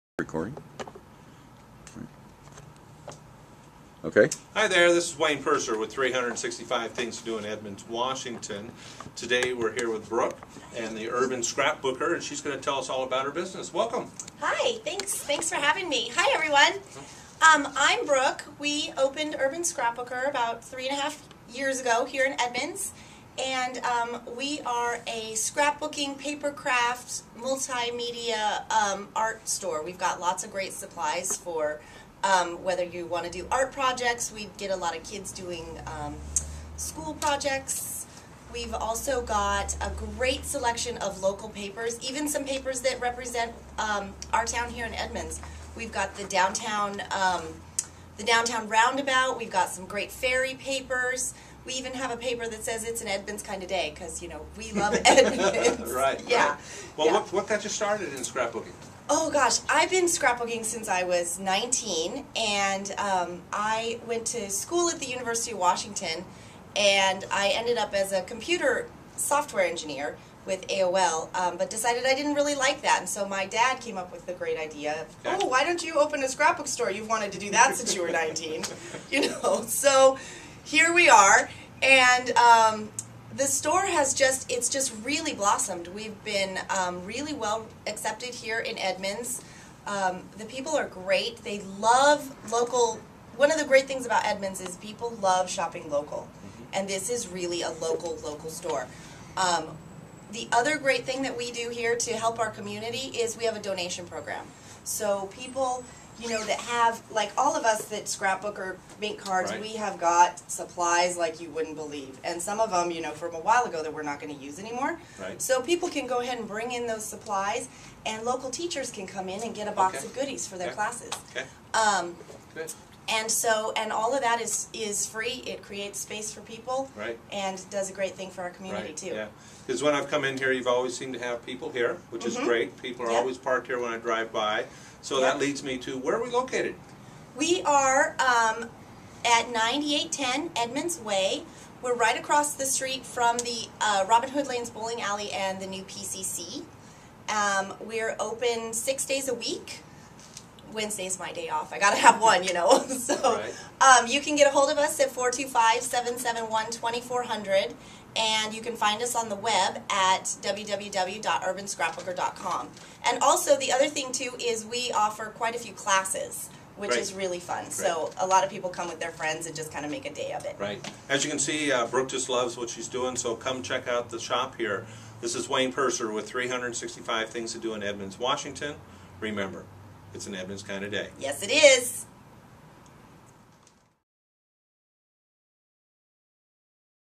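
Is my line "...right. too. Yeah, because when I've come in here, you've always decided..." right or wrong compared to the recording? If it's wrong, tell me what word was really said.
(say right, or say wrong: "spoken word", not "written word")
wrong: "seemed", not "decided".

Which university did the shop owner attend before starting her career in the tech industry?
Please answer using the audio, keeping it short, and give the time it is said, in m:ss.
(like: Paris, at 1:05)
University of Washington, at 1:05.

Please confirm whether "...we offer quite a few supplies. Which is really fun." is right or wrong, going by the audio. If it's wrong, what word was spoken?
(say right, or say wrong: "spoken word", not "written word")
wrong: "classes", not "supplies".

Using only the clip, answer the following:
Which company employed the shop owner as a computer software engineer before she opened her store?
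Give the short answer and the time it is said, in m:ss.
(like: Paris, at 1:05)
AOL, at 1:10.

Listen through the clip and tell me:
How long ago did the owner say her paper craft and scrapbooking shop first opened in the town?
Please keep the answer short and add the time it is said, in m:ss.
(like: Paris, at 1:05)
3.5 years, at 0:20.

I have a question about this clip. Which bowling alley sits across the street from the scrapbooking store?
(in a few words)
Robin Hood Lanes.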